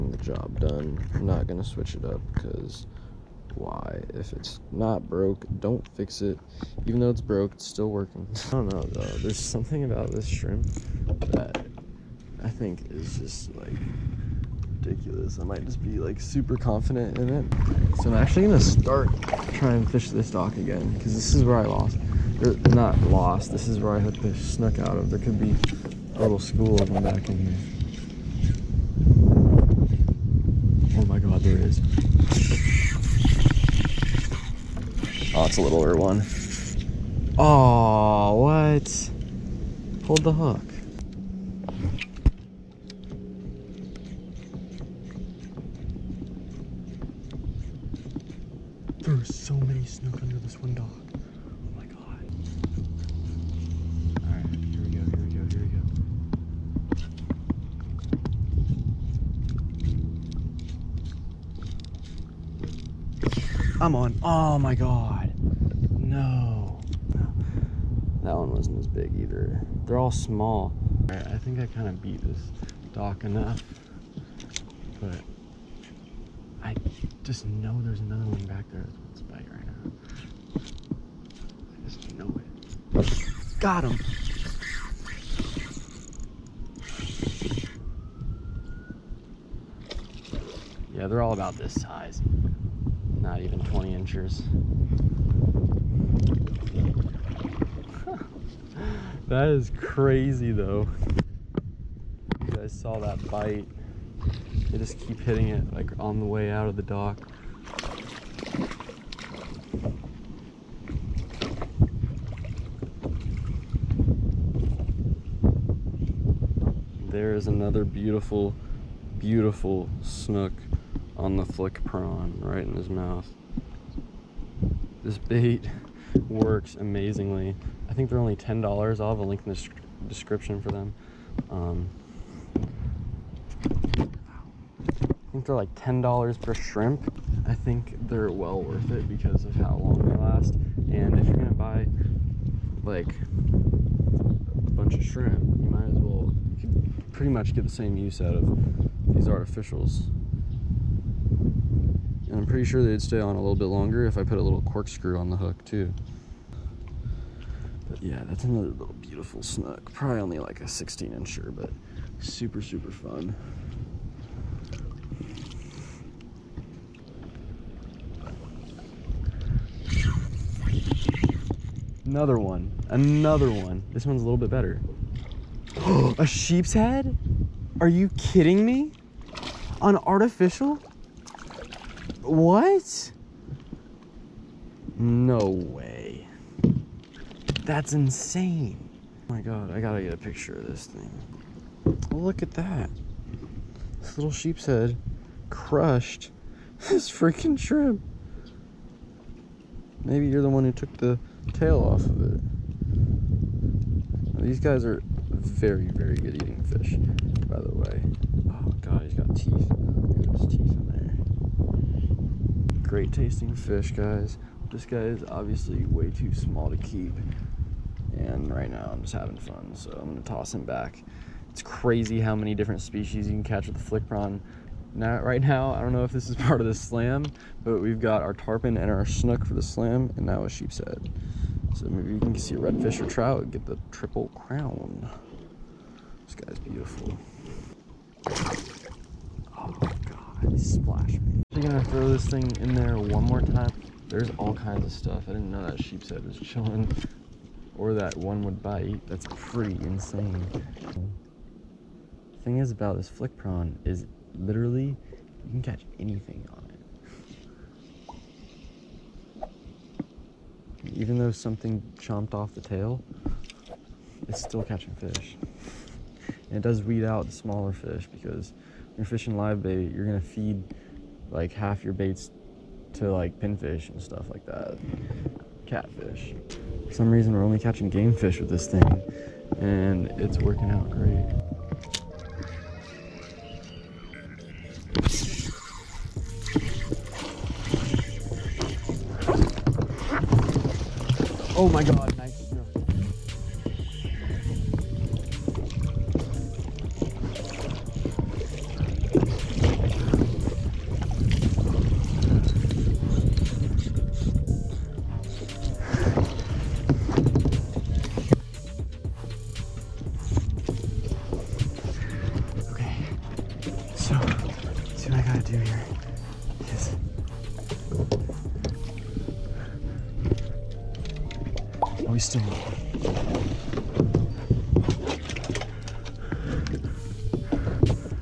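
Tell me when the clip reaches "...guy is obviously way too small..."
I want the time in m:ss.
3:34.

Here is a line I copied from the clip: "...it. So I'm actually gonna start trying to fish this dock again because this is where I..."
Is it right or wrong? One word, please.
right.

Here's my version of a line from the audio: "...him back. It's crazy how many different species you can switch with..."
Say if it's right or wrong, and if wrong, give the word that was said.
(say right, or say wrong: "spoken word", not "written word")
wrong: "catch", not "switch".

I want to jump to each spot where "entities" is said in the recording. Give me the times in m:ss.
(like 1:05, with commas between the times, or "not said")
not said.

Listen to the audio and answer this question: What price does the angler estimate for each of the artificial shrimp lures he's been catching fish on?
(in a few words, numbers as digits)
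$10.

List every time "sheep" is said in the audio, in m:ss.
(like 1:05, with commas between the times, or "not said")
2:56, 3:14, 3:50, 4:05.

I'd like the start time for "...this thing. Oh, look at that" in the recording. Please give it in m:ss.
3:10.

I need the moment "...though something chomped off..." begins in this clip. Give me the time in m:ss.
4:21.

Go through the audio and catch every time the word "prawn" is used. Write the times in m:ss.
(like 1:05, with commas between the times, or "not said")
2:01, 3:44, 4:13.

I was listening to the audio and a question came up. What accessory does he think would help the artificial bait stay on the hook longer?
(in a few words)
corkscrew.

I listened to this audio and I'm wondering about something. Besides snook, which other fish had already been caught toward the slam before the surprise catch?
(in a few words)
tarpon.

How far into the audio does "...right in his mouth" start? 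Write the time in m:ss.
2:02.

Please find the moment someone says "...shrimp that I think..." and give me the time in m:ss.
0:10.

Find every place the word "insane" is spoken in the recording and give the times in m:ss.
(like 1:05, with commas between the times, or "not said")
3:07, 4:09.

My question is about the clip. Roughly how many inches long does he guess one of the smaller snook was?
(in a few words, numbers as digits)
16 inches.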